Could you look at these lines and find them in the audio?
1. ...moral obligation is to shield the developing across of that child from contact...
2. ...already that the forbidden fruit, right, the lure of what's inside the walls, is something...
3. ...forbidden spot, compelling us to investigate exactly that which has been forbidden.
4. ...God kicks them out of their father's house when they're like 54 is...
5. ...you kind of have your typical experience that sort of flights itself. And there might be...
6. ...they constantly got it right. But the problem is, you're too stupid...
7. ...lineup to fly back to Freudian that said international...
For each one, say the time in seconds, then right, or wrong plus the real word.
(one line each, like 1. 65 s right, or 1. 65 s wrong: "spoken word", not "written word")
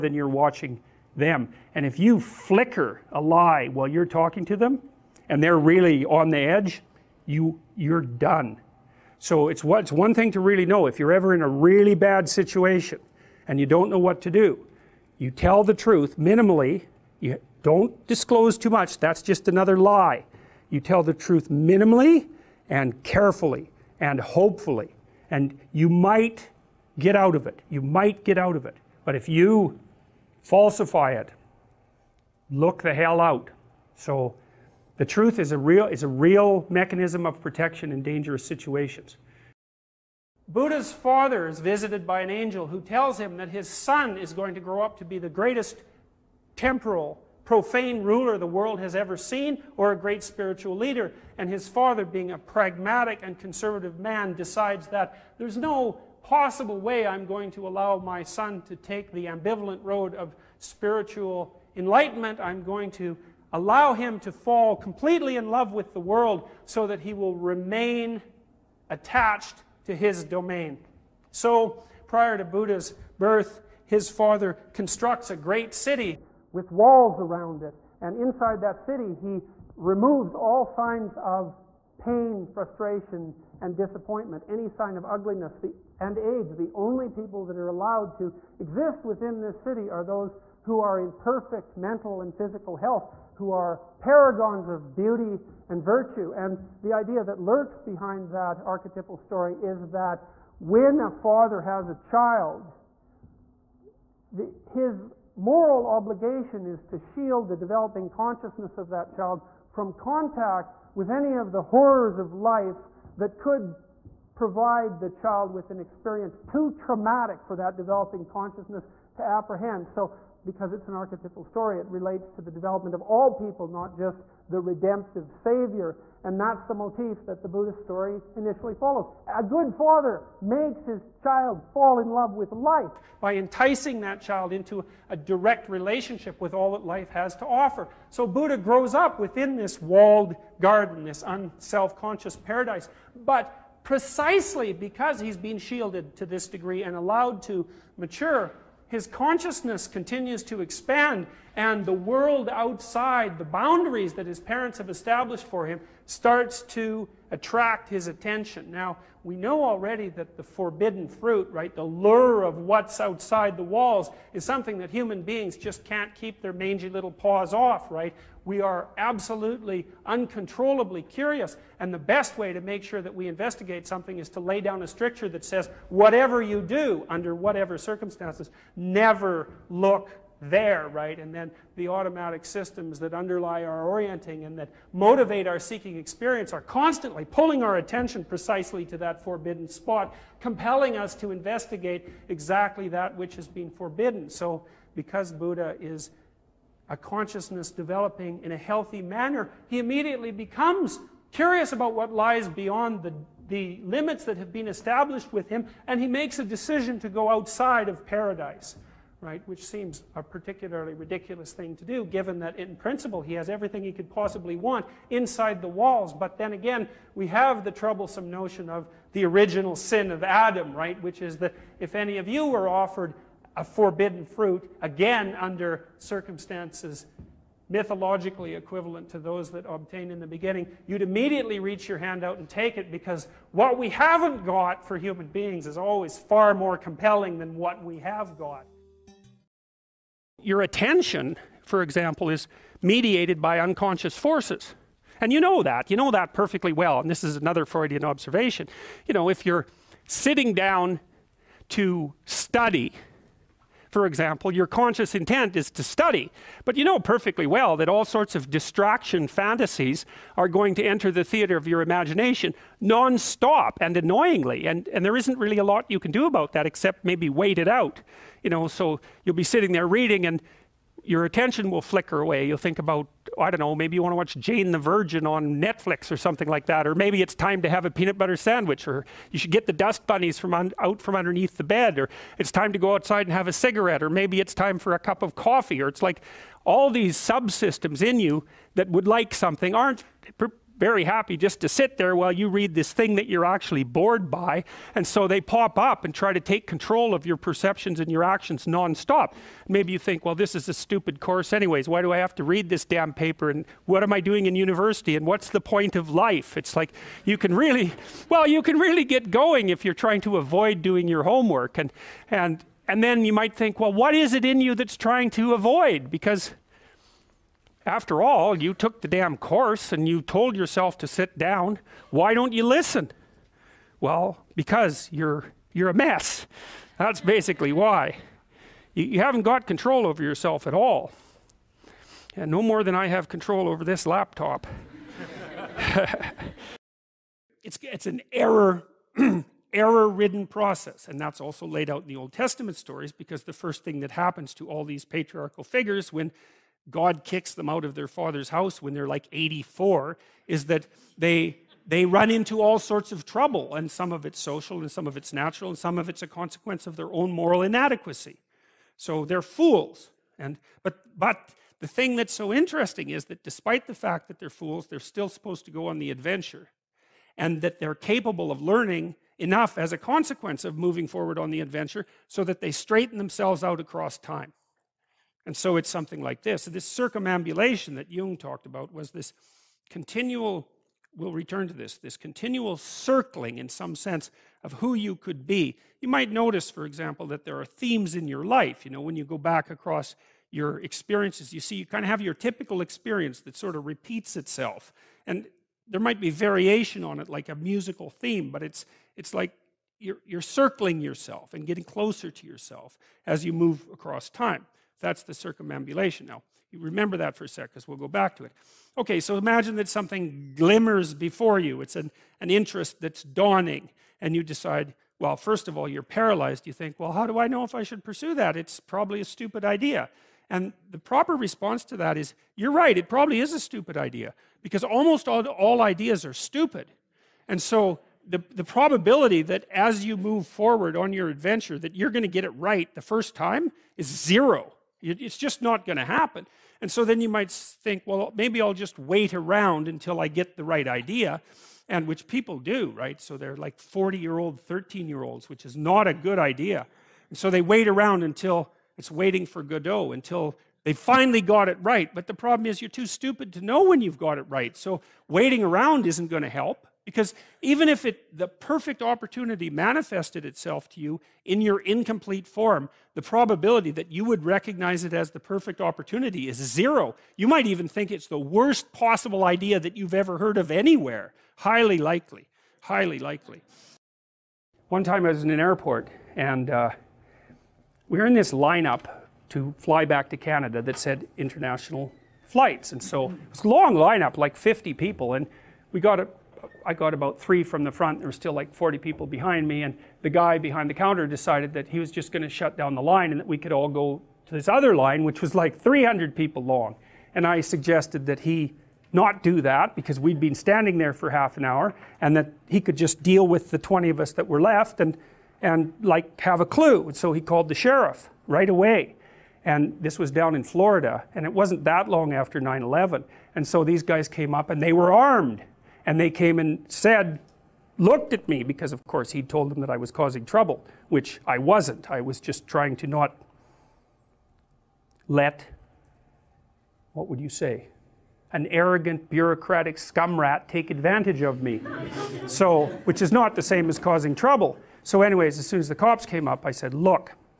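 1. 105 s wrong: "consciousness", not "across"
2. 159 s wrong: "outside", not "inside"
3. 189 s right
4. 346 s wrong: "84", not "54"
5. 391 s wrong: "repeats", not "flights"
6. 450 s wrong: "finally", not "constantly"
7. 478 s wrong: "Canada", not "Freudian".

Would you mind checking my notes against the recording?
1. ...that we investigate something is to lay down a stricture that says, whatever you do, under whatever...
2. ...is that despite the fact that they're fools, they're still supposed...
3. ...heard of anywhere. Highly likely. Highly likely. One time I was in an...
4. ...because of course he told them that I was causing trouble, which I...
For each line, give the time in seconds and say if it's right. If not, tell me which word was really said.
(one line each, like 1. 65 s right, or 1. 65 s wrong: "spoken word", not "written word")
1. 173 s right
2. 363 s right
3. 470 s right
4. 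518 s right.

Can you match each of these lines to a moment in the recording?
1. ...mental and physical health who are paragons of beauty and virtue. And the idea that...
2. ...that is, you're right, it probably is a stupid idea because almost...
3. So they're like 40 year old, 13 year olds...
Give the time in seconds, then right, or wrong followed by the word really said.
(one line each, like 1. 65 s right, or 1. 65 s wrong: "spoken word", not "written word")
1. 91 s right
2. 421 s right
3. 443 s right.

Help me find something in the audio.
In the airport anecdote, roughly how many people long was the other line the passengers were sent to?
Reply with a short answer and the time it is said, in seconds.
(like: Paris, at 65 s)
300, at 495 s.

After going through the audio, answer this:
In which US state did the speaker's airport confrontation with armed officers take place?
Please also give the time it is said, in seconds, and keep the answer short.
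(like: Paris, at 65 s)
Florida, at 510 s.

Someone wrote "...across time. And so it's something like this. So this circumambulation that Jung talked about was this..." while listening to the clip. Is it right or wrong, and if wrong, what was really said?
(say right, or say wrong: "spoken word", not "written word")
right.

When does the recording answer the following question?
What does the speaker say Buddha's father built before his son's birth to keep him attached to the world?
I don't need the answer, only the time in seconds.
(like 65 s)
75 s.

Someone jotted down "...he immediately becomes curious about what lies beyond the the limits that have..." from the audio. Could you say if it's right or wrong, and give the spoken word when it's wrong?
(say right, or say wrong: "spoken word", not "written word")
right.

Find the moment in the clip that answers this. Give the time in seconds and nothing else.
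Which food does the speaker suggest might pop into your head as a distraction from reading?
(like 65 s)
277 s.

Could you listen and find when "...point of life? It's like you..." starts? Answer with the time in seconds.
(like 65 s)
305 s.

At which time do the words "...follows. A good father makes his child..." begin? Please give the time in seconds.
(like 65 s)
128 s.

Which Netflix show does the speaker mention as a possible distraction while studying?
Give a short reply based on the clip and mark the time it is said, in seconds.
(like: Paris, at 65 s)
Jane the Virgin, at 274 s.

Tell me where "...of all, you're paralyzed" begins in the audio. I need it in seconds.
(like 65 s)
415 s.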